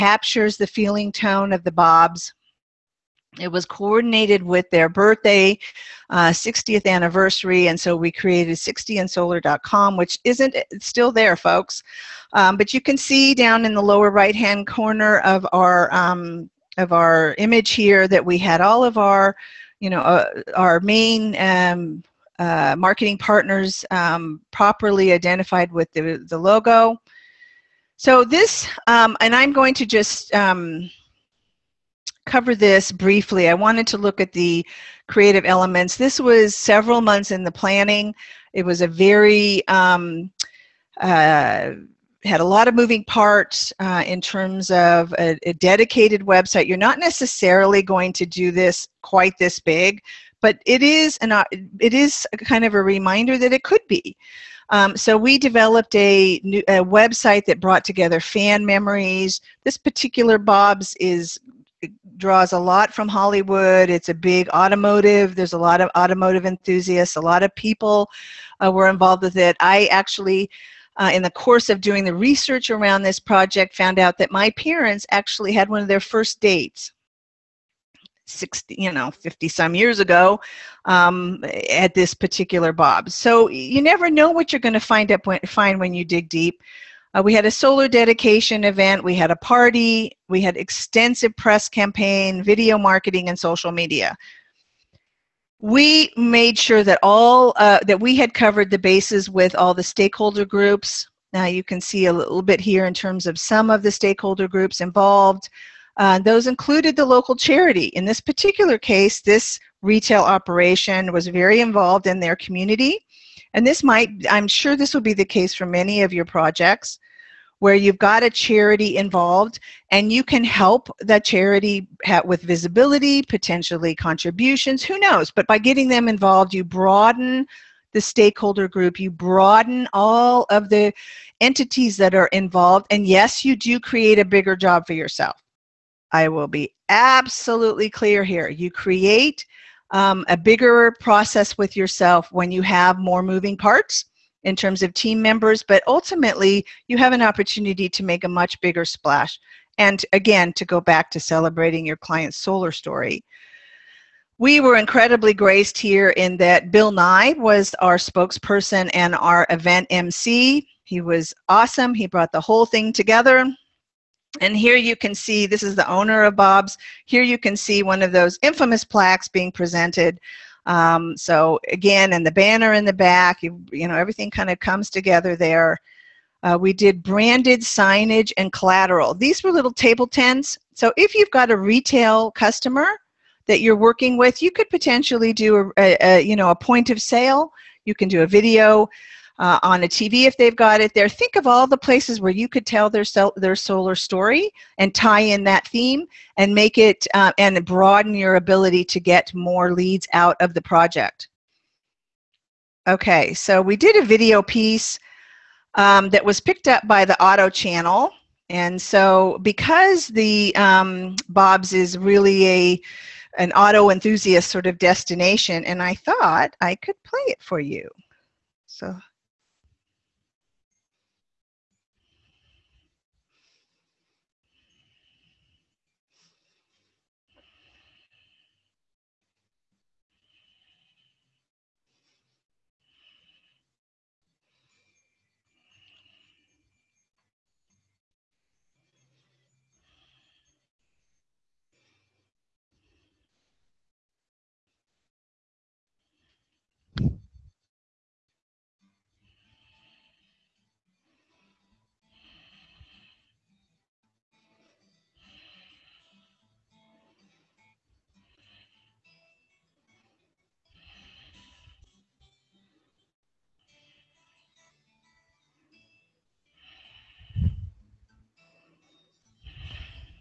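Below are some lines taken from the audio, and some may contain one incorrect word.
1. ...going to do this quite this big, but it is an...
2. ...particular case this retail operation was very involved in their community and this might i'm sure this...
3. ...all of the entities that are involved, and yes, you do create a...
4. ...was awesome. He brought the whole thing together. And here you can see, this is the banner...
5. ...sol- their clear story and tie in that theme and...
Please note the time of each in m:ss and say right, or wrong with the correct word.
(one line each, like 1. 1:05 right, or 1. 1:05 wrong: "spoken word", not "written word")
1. 0:47 right
2. 1:48 right
3. 2:09 right
4. 2:40 wrong: "owner", not "banner"
5. 3:13 wrong: "solar", not "clear".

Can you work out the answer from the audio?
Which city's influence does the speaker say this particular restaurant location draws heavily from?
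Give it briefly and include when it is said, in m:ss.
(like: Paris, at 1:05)
Hollywood, at 1:03.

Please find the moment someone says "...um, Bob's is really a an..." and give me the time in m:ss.
3:30.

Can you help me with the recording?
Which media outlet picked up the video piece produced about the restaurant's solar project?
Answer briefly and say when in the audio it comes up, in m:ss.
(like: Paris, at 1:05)
the Auto Channel, at 3:27.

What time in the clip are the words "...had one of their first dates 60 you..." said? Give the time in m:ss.
1:15.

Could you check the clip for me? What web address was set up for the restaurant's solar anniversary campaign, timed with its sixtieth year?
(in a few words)
60andsolar.com.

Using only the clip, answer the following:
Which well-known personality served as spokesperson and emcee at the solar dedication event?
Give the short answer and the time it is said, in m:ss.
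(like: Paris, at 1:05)
Bill Nye, at 2:36.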